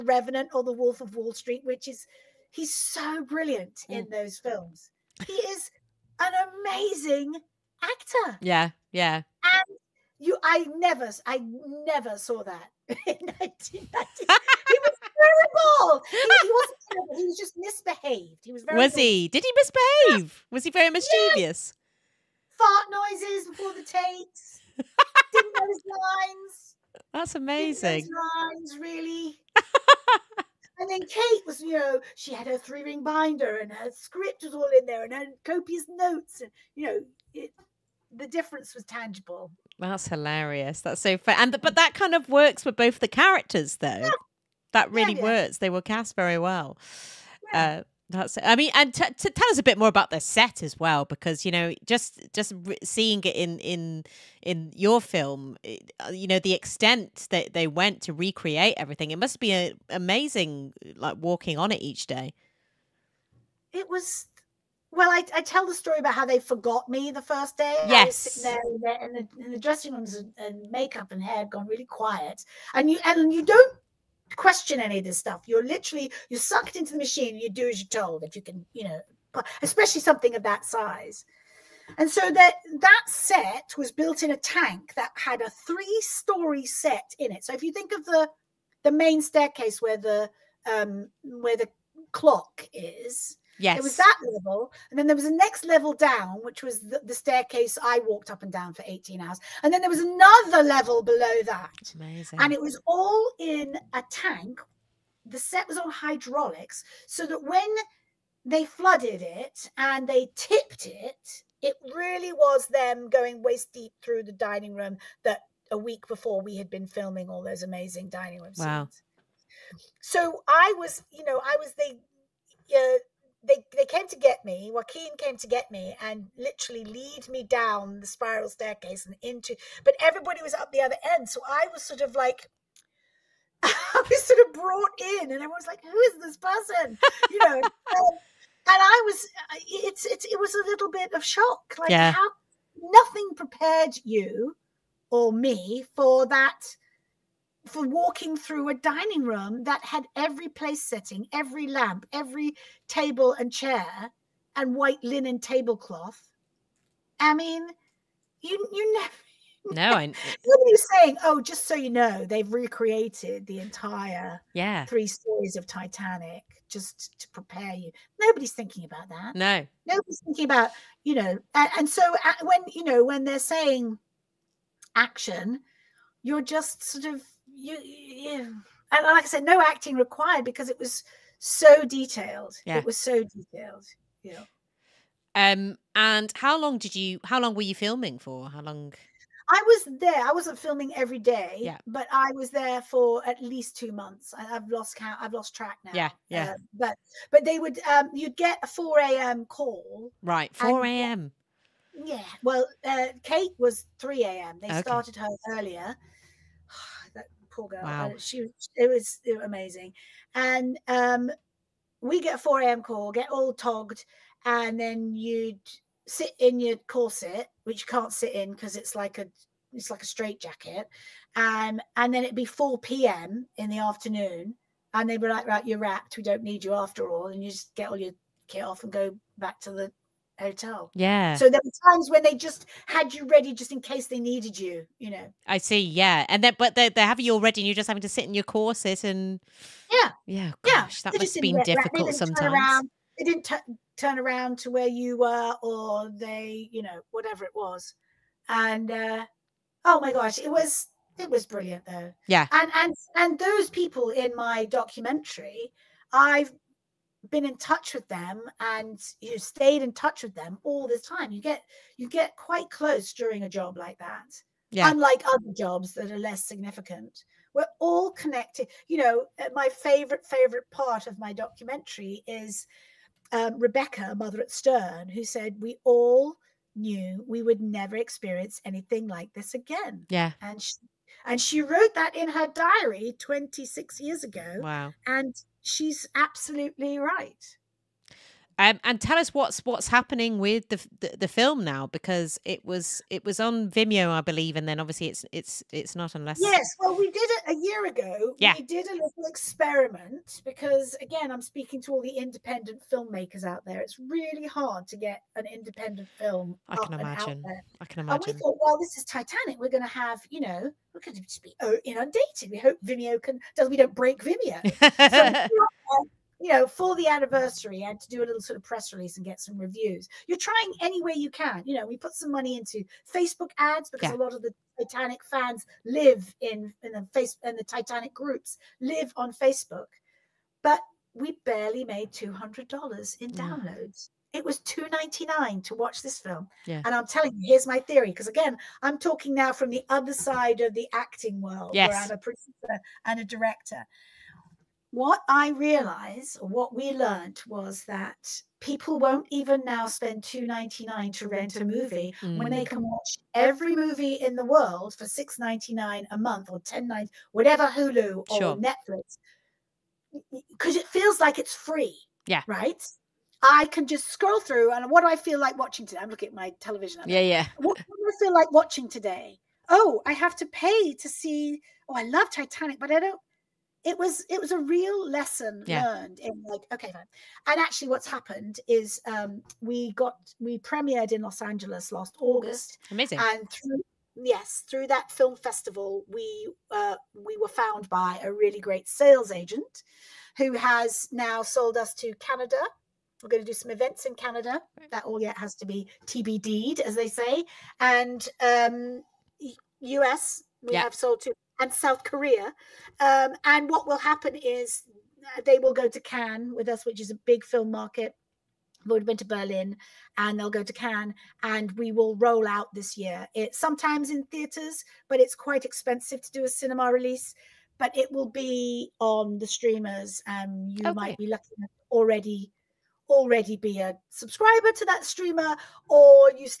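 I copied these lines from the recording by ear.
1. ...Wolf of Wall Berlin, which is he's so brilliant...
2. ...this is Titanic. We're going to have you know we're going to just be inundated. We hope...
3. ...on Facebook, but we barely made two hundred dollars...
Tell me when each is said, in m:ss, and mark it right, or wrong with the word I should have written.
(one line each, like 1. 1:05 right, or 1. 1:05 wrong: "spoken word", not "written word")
1. 0:00 wrong: "Street", not "Berlin"
2. 5:08 right
3. 5:29 right.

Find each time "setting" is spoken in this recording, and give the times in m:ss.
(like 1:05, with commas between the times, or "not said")
2:30.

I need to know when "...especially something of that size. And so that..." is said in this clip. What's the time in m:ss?
1:19.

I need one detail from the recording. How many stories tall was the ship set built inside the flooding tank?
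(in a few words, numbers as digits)
3.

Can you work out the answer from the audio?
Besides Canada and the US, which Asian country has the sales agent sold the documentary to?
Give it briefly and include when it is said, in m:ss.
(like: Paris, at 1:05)
South Korea, at 6:41.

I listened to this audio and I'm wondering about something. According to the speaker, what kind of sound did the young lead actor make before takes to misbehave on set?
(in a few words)
Fart noises.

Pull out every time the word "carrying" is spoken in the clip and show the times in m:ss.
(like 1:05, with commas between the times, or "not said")
not said.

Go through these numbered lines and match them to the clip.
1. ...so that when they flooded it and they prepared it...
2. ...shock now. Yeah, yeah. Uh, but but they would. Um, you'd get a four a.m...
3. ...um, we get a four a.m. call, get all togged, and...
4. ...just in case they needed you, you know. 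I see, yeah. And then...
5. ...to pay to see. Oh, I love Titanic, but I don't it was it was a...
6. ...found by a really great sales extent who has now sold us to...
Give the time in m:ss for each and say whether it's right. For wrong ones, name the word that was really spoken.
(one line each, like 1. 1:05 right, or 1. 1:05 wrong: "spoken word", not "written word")
1. 1:47 wrong: "tipped", not "prepared"
2. 3:15 wrong: "track", not "shock"
3. 3:30 right
4. 3:53 right
5. 6:10 right
6. 6:27 wrong: "agent", not "extent".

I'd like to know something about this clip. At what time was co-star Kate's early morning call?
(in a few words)
3 a.m.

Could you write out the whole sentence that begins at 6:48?
we have already been to Berlin, and they'll go to Cannes, and we will roll out this year.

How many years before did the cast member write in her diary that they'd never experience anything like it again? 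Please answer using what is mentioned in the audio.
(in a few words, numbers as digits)
26.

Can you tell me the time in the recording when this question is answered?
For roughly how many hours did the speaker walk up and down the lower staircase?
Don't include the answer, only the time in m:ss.
1:38.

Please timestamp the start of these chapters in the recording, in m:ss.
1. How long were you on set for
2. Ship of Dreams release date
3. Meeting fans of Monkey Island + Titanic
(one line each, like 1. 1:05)
1. 2:14
2. 3:58
3. 6:34.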